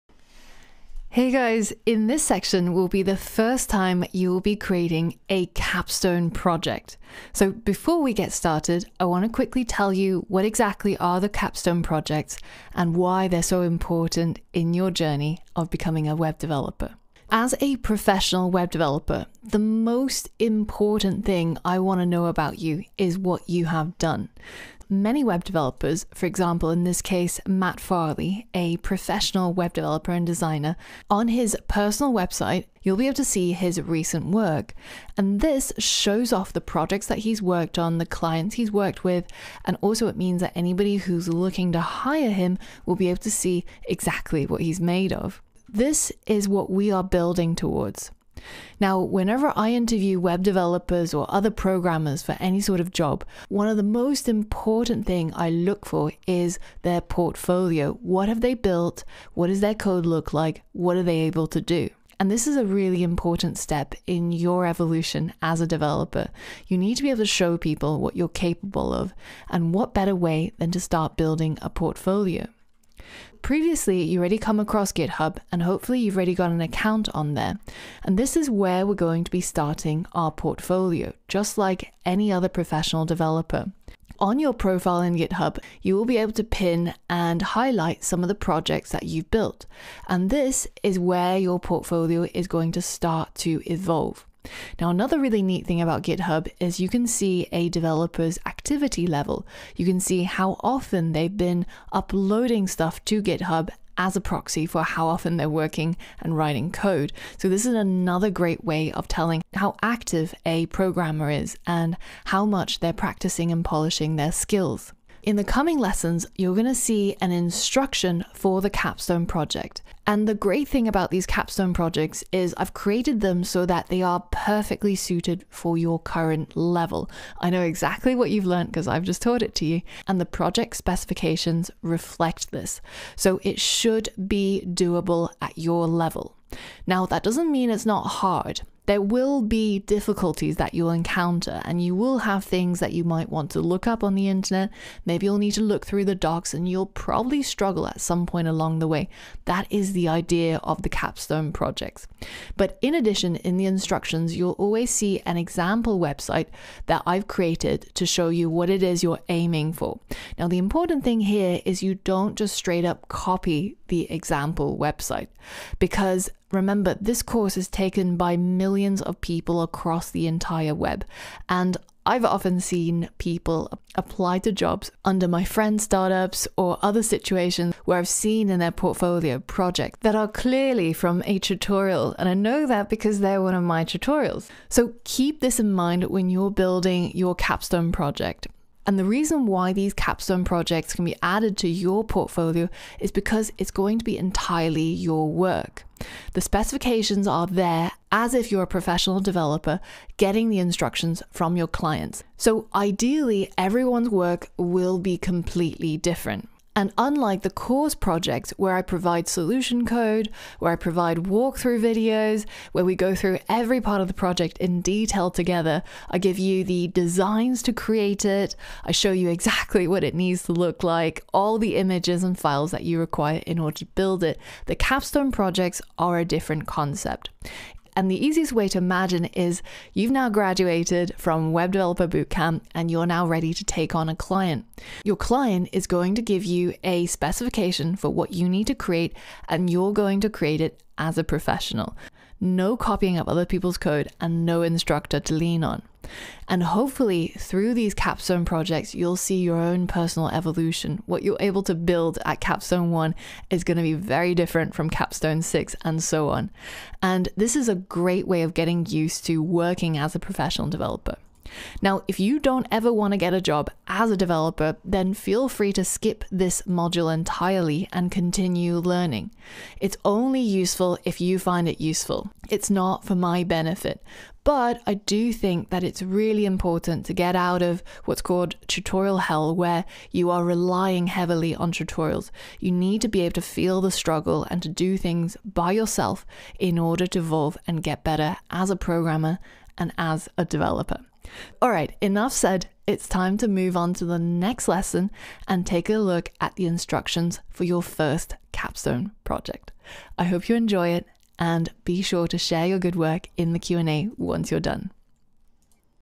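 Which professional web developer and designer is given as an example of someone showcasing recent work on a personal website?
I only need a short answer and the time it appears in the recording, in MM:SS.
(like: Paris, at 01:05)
Matt Farley, at 00:27.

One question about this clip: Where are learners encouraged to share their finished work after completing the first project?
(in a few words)
The Q&A.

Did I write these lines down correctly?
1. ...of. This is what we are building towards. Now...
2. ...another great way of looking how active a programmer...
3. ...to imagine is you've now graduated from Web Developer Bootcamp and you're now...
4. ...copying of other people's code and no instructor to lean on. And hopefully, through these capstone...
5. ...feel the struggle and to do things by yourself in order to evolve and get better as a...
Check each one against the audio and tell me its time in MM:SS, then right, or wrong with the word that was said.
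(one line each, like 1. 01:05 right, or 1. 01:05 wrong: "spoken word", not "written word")
1. 00:45 right
2. 01:47 wrong: "telling", not "looking"
3. 03:48 right
4. 04:02 right
5. 04:43 right.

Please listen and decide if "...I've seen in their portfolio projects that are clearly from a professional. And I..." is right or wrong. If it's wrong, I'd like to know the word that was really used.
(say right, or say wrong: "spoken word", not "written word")
wrong: "tutorial", not "professional".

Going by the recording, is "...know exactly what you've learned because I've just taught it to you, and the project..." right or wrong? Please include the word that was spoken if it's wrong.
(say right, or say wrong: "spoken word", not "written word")
right.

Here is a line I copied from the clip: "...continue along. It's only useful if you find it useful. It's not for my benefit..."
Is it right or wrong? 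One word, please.
wrong.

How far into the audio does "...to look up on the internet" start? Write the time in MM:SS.
02:23.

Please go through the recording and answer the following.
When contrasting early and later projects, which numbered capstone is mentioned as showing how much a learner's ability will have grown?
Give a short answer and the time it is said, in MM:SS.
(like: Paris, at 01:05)
Capstone six, at 04:14.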